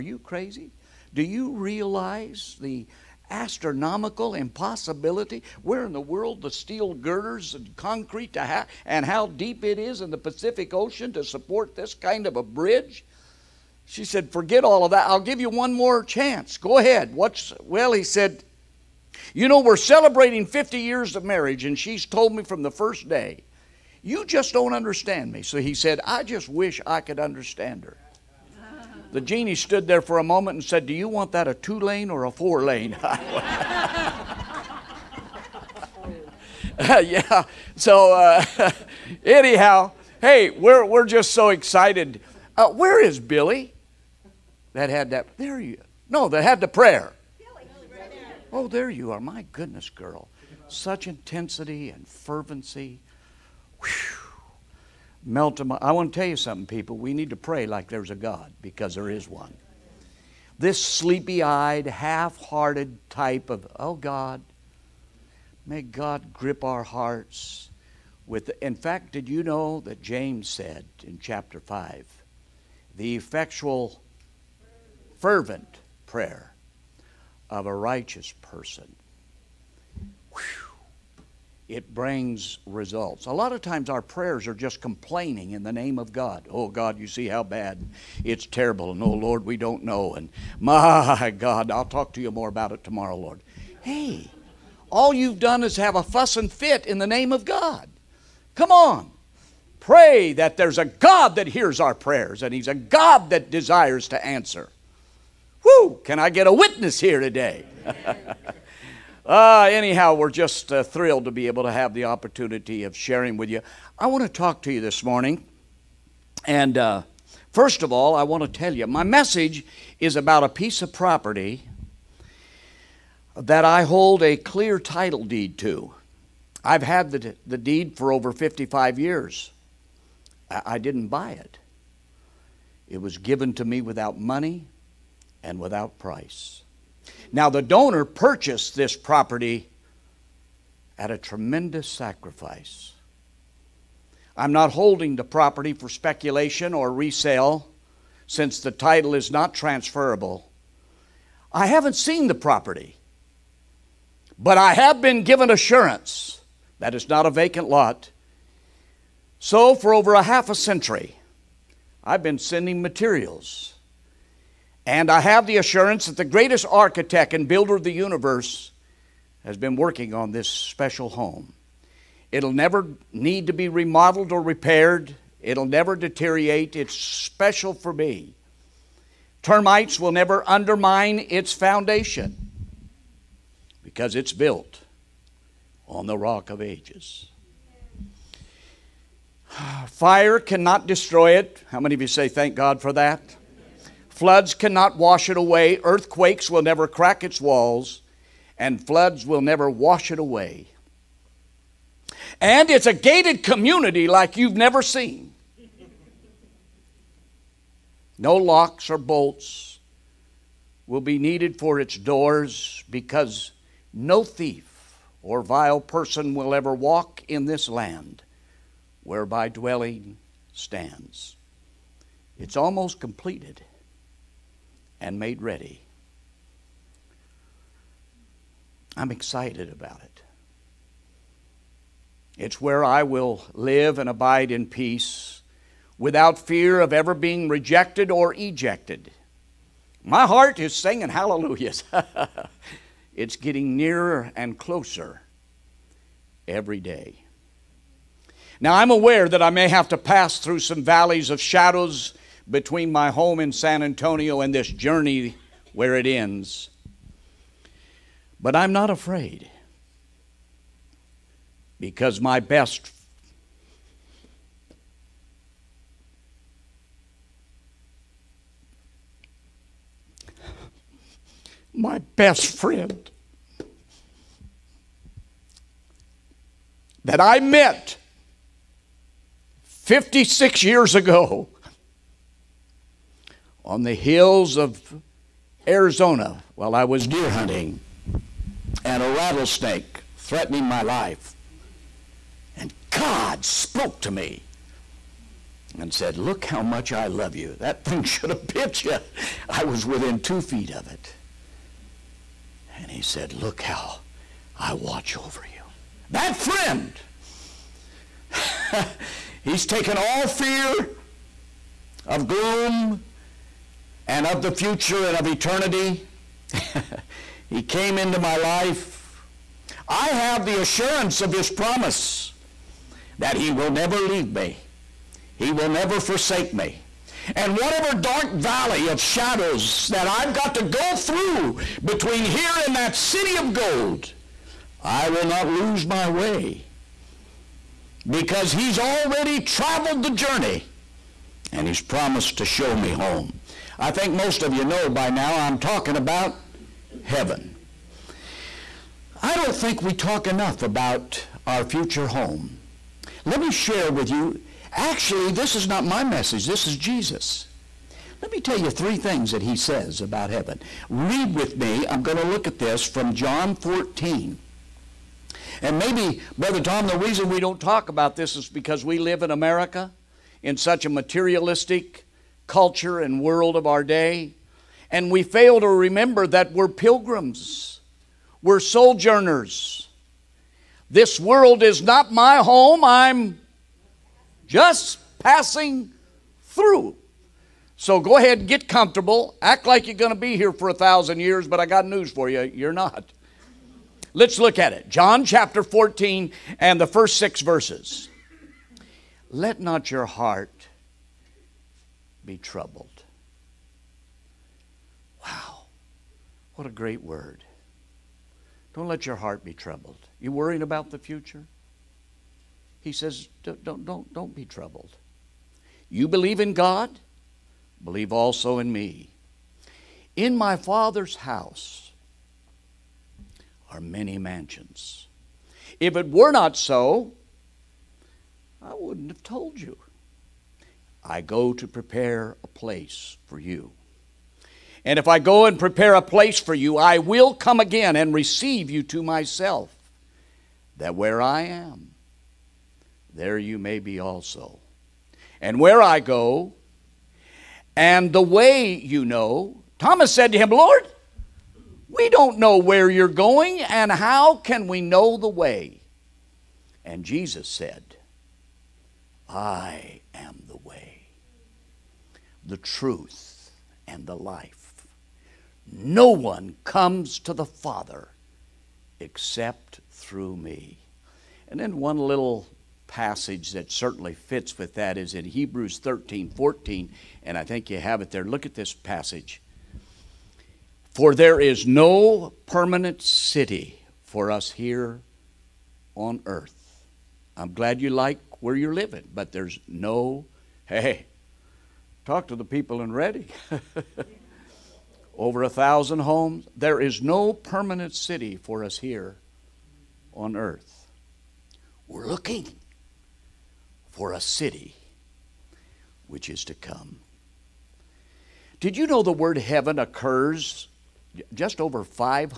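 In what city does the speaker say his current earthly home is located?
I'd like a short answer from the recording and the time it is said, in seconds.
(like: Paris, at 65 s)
San Antonio, at 253 s.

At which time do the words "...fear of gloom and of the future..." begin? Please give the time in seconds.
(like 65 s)
310 s.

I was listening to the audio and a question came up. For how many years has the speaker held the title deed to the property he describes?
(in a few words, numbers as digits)
Over 55 years.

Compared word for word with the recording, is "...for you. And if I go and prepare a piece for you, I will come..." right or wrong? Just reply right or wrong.
wrong.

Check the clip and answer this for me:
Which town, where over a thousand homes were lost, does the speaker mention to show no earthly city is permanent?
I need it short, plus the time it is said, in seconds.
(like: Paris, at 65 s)
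Redding, at 492 s.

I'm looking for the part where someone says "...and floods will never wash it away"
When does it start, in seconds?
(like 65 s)
198 s.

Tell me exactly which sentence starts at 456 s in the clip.
And Jesus said, I am the truth, and the life.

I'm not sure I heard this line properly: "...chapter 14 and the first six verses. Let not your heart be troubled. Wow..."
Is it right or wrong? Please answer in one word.
right.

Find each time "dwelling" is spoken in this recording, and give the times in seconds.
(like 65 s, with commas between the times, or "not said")
219 s.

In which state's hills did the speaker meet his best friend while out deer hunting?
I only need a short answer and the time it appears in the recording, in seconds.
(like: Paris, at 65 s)
Arizona, at 285 s.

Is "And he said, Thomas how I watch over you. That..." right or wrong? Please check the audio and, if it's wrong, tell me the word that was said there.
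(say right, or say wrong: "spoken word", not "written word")
wrong: "Look", not "Thomas".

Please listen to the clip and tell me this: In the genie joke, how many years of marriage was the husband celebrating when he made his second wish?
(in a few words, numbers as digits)
50.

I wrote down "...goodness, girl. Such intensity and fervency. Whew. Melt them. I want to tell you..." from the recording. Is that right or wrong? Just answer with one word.
right.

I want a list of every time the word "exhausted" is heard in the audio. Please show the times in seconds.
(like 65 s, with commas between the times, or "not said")
not said.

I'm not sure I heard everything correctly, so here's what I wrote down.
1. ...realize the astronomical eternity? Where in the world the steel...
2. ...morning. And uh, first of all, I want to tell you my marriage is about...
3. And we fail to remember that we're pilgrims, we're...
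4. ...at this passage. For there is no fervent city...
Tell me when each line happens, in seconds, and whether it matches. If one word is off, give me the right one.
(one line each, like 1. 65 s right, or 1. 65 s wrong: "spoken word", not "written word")
1. 1 s wrong: "impossibility", not "eternity"
2. 115 s wrong: "message", not "marriage"
3. 374 s right
4. 478 s wrong: "permanent", not "fervent".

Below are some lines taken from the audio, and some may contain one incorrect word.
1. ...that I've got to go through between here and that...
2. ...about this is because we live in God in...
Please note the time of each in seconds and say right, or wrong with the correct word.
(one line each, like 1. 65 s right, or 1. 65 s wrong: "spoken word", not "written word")
1. 329 s right
2. 367 s wrong: "America", not "God".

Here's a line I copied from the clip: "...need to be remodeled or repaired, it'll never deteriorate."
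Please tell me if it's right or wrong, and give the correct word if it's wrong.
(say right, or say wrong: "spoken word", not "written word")
right.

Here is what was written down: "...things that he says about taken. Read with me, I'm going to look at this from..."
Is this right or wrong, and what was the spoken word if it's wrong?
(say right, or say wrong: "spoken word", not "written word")
wrong: "heaven", not "taken".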